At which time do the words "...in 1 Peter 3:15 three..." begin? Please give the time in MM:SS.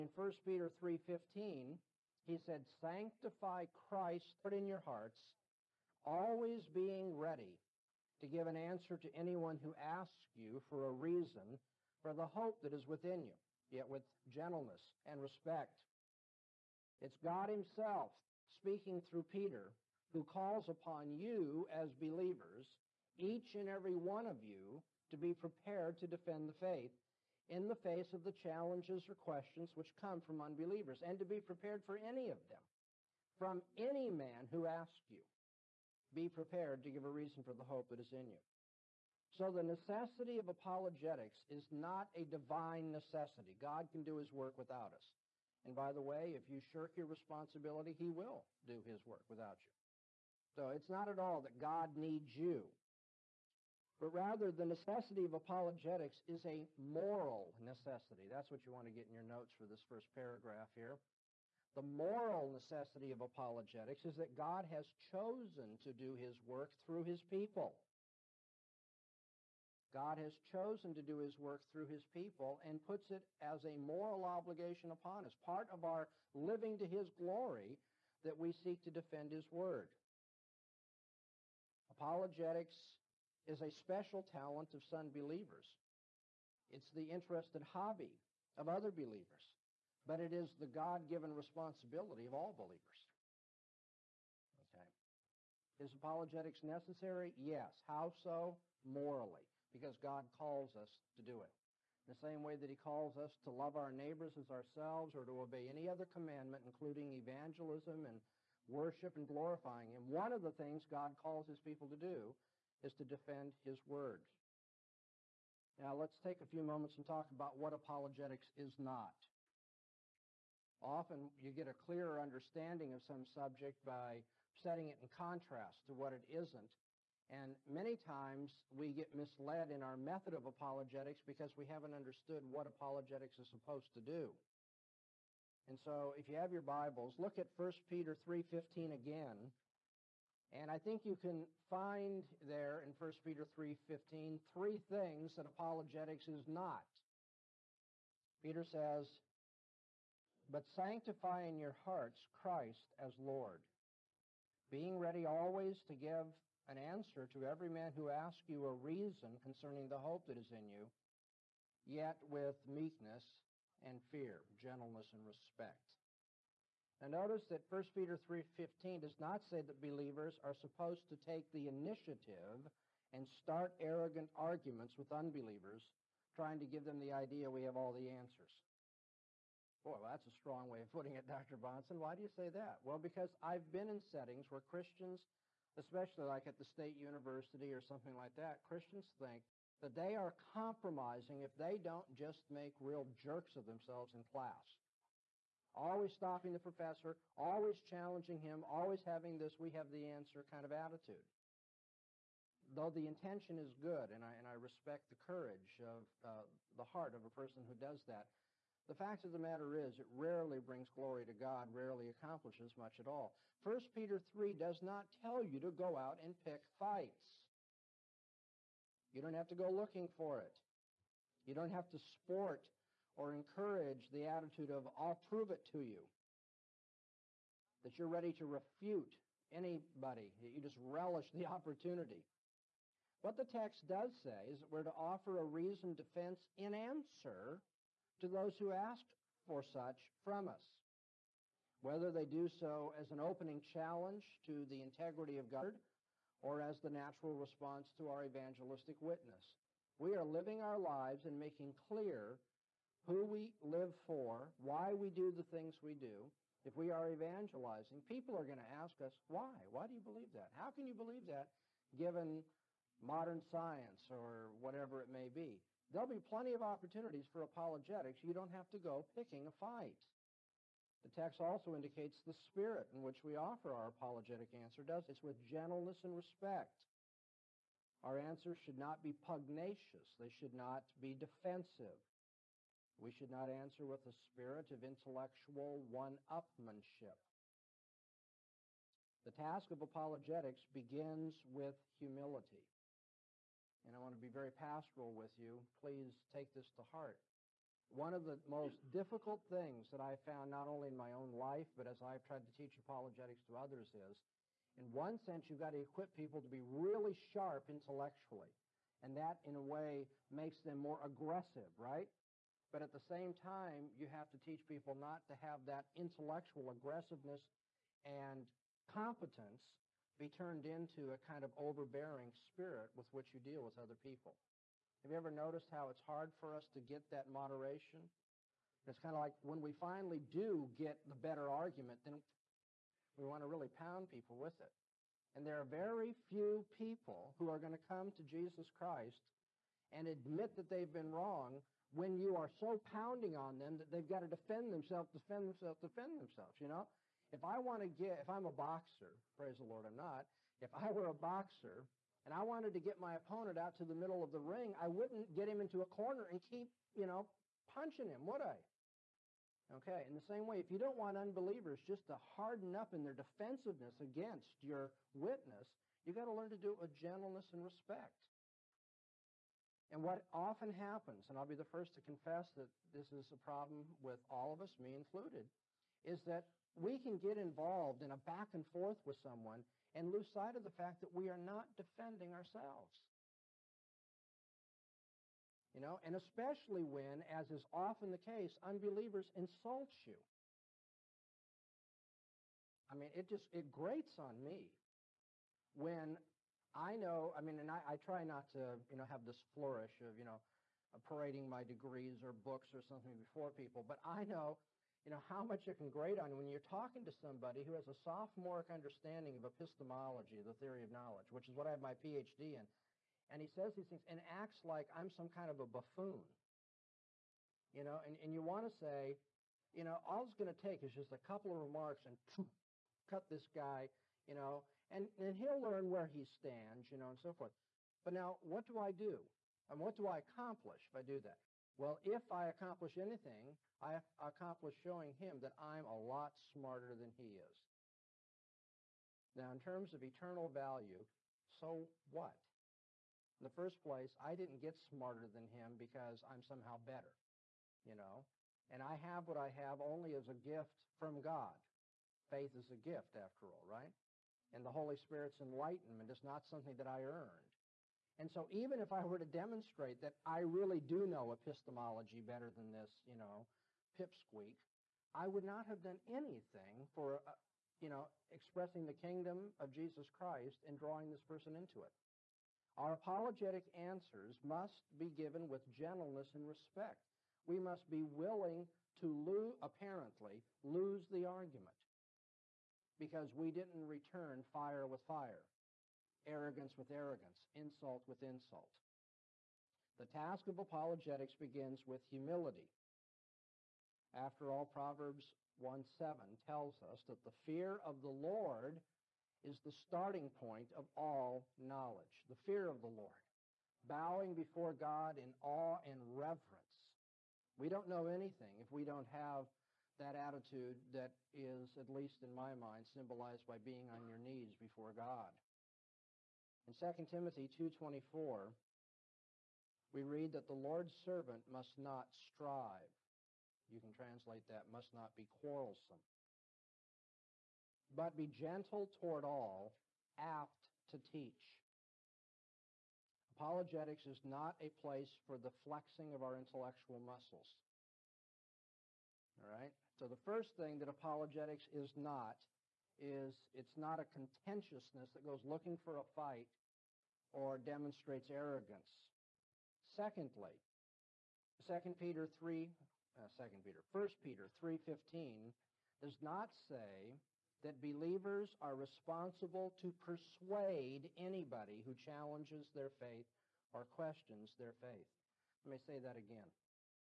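02:22.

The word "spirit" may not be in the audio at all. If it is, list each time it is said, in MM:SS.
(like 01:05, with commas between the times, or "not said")
04:32, 04:44, 05:22, 07:34.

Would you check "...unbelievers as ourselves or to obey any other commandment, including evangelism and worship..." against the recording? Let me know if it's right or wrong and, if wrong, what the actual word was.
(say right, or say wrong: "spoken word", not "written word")
wrong: "neighbors", not "unbelievers".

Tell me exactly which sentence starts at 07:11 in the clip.
Well, if I accomplish anything, I accomplish showing him that I'm a lot smarter than he is.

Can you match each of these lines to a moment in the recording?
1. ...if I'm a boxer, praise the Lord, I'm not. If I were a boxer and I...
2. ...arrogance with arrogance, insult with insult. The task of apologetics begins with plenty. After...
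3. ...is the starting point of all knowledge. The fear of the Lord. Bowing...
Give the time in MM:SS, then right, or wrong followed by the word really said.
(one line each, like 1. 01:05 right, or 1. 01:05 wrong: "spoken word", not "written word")
1. 05:48 right
2. 08:06 wrong: "humility", not "plenty"
3. 08:19 right.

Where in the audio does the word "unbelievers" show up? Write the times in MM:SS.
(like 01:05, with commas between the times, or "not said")
00:30, 02:55, 06:01, 06:28.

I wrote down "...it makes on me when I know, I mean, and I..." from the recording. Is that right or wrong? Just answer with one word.
wrong.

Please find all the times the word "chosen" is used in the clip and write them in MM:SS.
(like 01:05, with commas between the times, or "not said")
01:04, 01:10.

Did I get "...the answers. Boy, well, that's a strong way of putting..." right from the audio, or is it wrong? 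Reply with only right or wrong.
right.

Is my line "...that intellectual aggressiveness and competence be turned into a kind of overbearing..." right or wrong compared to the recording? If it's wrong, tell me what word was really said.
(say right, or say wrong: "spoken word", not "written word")
right.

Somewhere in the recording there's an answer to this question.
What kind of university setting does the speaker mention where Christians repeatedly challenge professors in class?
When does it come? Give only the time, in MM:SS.
03:06.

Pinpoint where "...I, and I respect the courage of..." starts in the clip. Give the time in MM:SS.
03:24.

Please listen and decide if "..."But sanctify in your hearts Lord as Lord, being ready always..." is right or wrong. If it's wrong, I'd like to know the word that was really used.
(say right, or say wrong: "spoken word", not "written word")
wrong: "Christ", not "Lord".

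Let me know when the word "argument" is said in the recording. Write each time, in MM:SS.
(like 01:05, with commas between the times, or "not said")
02:54, 05:31, 08:01.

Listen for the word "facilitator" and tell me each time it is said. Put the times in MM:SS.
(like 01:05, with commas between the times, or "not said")
not said.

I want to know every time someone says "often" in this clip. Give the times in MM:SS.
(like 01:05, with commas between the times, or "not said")
02:00, 06:10, 06:27.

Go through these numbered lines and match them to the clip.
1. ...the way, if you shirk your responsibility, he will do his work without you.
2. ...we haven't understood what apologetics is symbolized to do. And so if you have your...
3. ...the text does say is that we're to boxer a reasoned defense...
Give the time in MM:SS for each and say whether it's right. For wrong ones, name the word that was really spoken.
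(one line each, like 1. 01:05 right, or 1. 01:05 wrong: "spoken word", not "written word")
1. 00:45 right
2. 02:11 wrong: "supposed", not "symbolized"
3. 03:53 wrong: "offer", not "boxer".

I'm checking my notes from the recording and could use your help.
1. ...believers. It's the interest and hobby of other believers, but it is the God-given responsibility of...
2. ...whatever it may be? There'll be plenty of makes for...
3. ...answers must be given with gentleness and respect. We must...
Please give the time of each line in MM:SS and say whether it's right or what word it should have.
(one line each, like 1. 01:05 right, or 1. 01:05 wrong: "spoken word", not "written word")
1. 01:25 right
2. 04:24 wrong: "opportunities", not "makes"
3. 07:53 right.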